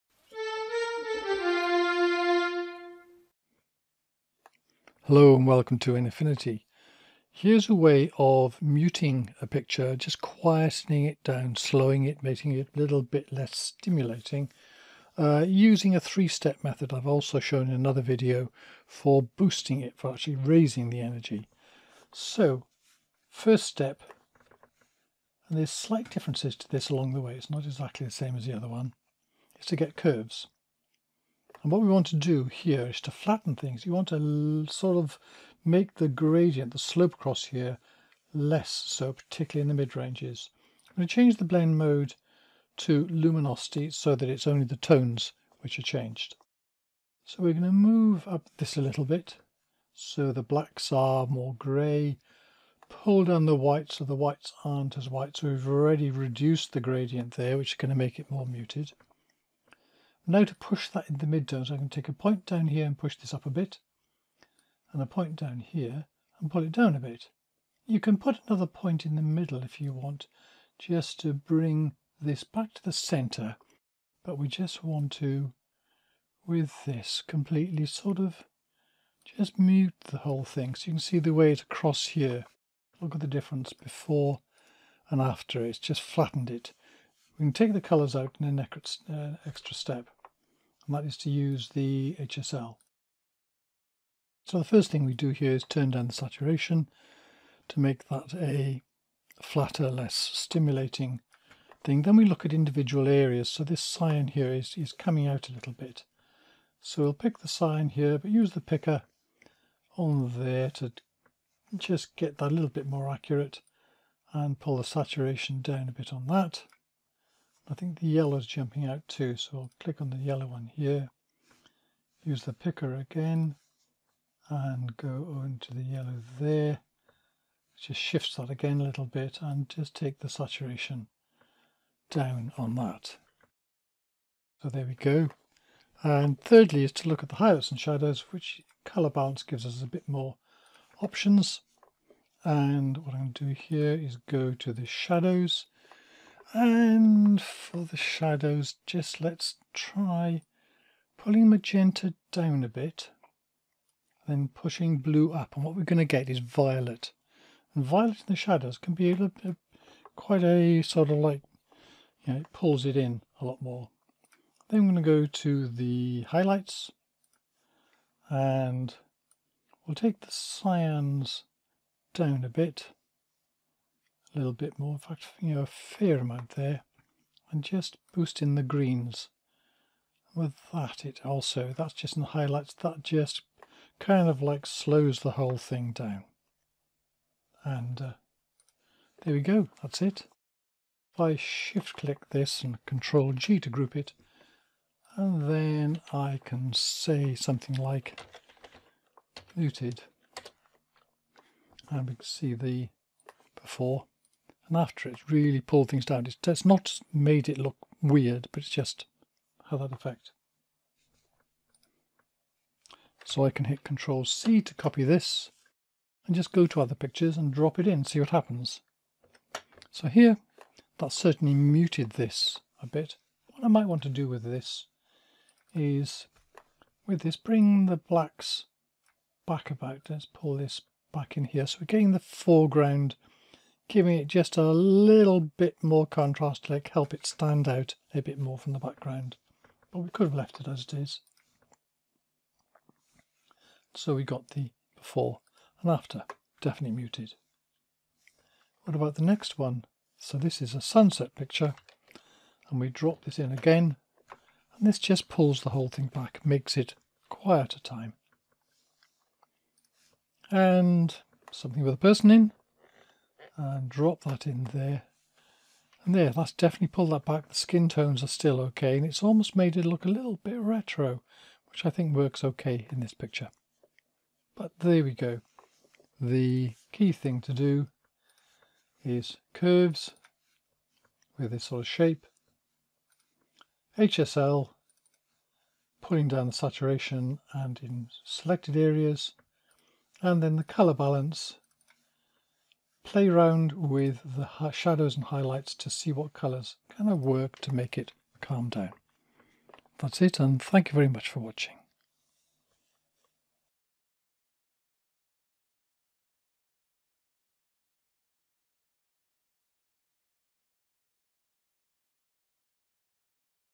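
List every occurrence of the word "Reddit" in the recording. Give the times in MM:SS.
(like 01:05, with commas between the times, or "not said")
not said.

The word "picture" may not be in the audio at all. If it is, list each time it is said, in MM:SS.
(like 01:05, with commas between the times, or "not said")
00:09, 03:36, 04:11, 04:33.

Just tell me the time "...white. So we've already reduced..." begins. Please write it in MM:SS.
00:55.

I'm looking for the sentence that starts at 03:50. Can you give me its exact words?
Let's pull this back in here.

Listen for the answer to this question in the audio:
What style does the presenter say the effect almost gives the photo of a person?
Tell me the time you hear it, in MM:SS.
04:30.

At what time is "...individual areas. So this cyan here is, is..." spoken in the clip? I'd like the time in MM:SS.
01:42.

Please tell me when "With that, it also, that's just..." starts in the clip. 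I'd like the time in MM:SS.
03:00.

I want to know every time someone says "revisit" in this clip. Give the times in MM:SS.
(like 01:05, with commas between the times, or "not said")
not said.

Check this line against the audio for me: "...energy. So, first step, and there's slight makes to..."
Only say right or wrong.
wrong.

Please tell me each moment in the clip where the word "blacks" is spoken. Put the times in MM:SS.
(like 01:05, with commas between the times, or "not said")
00:50, 03:47.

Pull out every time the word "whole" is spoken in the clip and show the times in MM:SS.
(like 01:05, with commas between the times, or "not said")
01:20, 03:05, 04:15.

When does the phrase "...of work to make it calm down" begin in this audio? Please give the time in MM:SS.
04:57.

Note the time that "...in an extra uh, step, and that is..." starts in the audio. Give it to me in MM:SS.
01:28.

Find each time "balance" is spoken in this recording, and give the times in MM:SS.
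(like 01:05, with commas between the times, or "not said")
02:19, 04:50.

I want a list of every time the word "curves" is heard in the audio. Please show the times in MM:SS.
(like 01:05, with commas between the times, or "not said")
00:29, 04:39.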